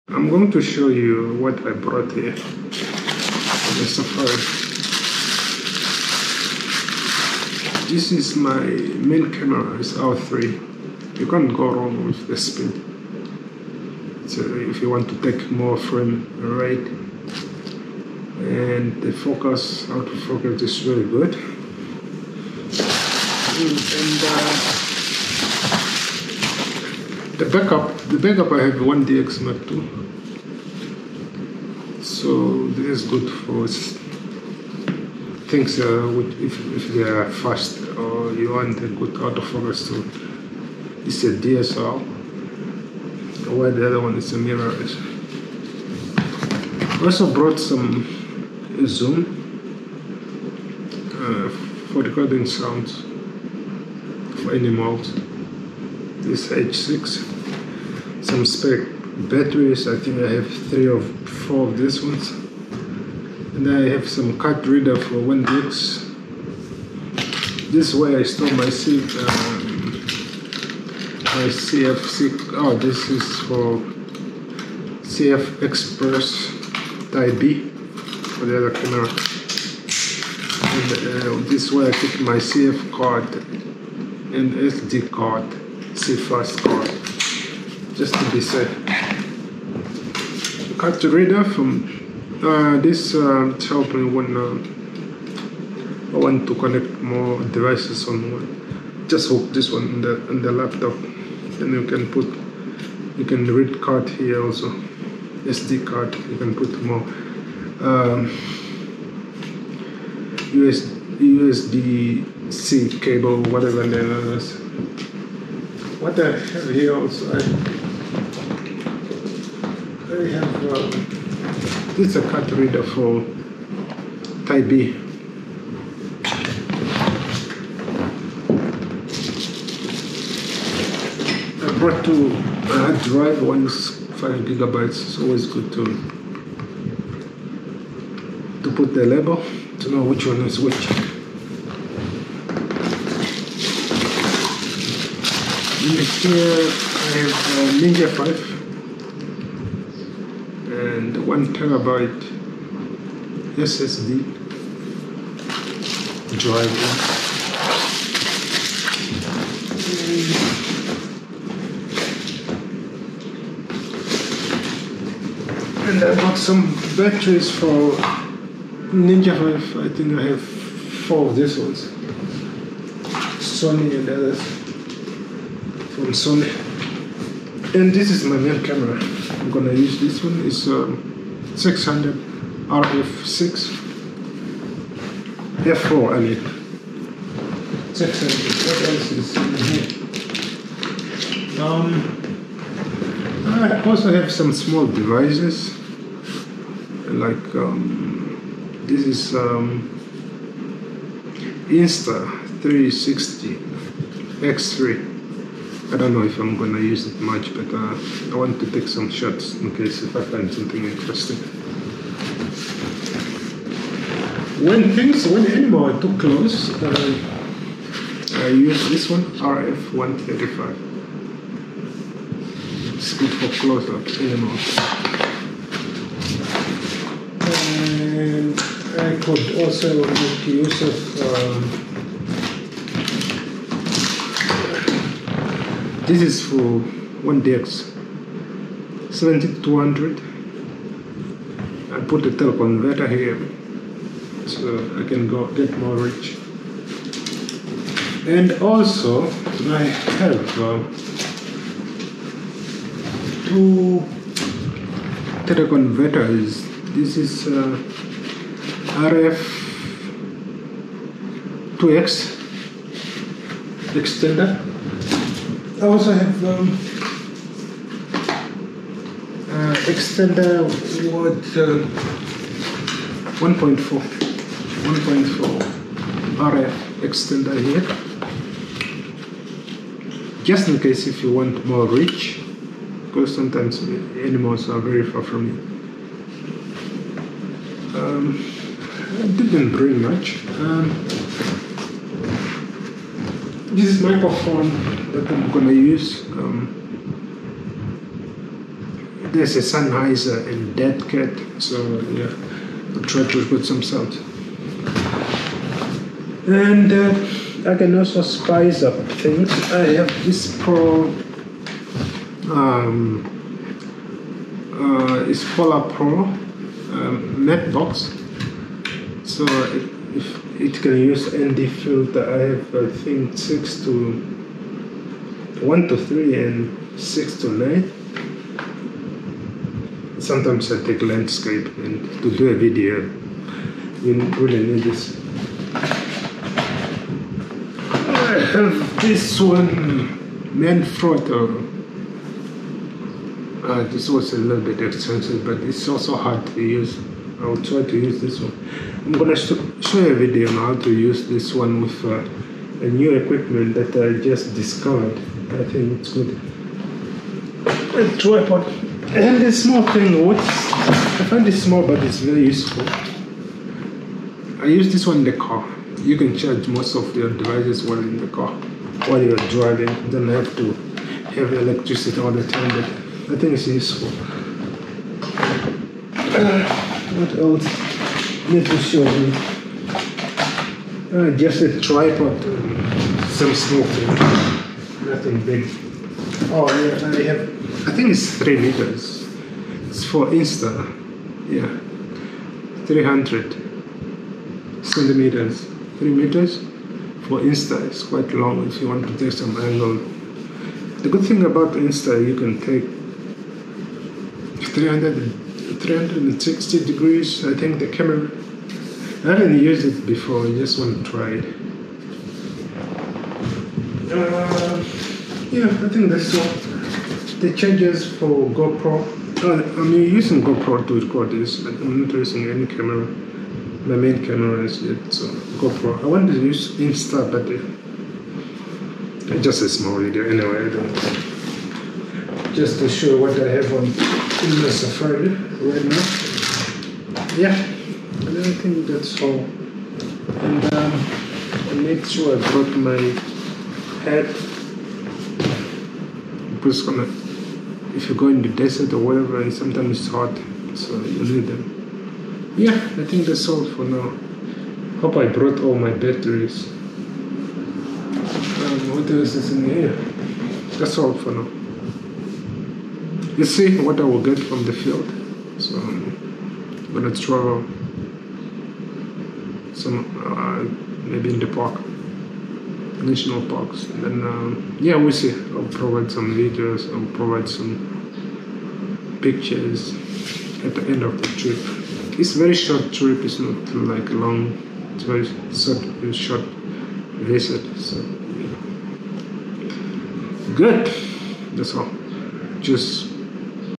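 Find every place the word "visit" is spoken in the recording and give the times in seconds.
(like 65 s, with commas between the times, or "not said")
487 s.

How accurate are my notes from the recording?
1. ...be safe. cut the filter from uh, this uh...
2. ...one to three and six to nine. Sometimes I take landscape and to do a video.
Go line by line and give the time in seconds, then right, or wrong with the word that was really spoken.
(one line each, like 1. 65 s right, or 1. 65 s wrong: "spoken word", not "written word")
1. 88 s wrong: "reader", not "filter"
2. 325 s right.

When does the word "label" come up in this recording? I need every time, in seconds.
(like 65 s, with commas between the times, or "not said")
139 s.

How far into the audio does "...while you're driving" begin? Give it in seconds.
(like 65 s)
369 s.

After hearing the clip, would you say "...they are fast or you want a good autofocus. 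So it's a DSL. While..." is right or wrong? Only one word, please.
right.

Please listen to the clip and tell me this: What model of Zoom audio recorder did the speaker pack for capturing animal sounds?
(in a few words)
H6.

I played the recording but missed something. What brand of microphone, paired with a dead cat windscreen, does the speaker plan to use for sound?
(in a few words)
Sennheiser.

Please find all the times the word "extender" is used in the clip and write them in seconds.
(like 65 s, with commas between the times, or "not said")
263 s, 269 s, 277 s.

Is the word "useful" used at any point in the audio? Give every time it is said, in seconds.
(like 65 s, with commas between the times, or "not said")
362 s, 373 s.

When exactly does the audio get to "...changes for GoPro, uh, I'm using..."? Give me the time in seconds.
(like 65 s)
417 s.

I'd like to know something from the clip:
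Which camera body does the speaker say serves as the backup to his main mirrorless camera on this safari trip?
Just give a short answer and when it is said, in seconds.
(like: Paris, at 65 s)
1DX Mark II, at 28 s.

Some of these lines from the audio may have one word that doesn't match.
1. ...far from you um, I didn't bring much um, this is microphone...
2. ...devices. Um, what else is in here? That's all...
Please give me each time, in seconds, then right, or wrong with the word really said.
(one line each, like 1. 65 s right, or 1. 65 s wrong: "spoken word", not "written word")
1. 285 s right
2. 455 s wrong: "batteries", not "devices".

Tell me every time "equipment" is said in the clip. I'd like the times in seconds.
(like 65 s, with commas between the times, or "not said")
353 s.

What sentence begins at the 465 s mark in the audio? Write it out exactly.
So I'm gonna travel some uh, maybe in the park, national parks.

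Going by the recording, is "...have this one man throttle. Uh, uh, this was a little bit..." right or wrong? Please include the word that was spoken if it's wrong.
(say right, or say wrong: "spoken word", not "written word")
right.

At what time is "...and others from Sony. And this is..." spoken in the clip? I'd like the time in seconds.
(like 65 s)
173 s.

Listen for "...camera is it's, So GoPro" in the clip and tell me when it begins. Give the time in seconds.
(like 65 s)
424 s.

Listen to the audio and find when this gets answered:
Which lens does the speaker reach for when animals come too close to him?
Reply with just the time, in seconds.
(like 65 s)
219 s.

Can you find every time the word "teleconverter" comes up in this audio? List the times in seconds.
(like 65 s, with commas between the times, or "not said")
242 s, 255 s.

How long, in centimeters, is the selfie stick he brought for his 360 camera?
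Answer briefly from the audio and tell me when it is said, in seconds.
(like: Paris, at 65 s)
300, at 392 s.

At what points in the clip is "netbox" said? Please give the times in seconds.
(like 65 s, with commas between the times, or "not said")
317 s.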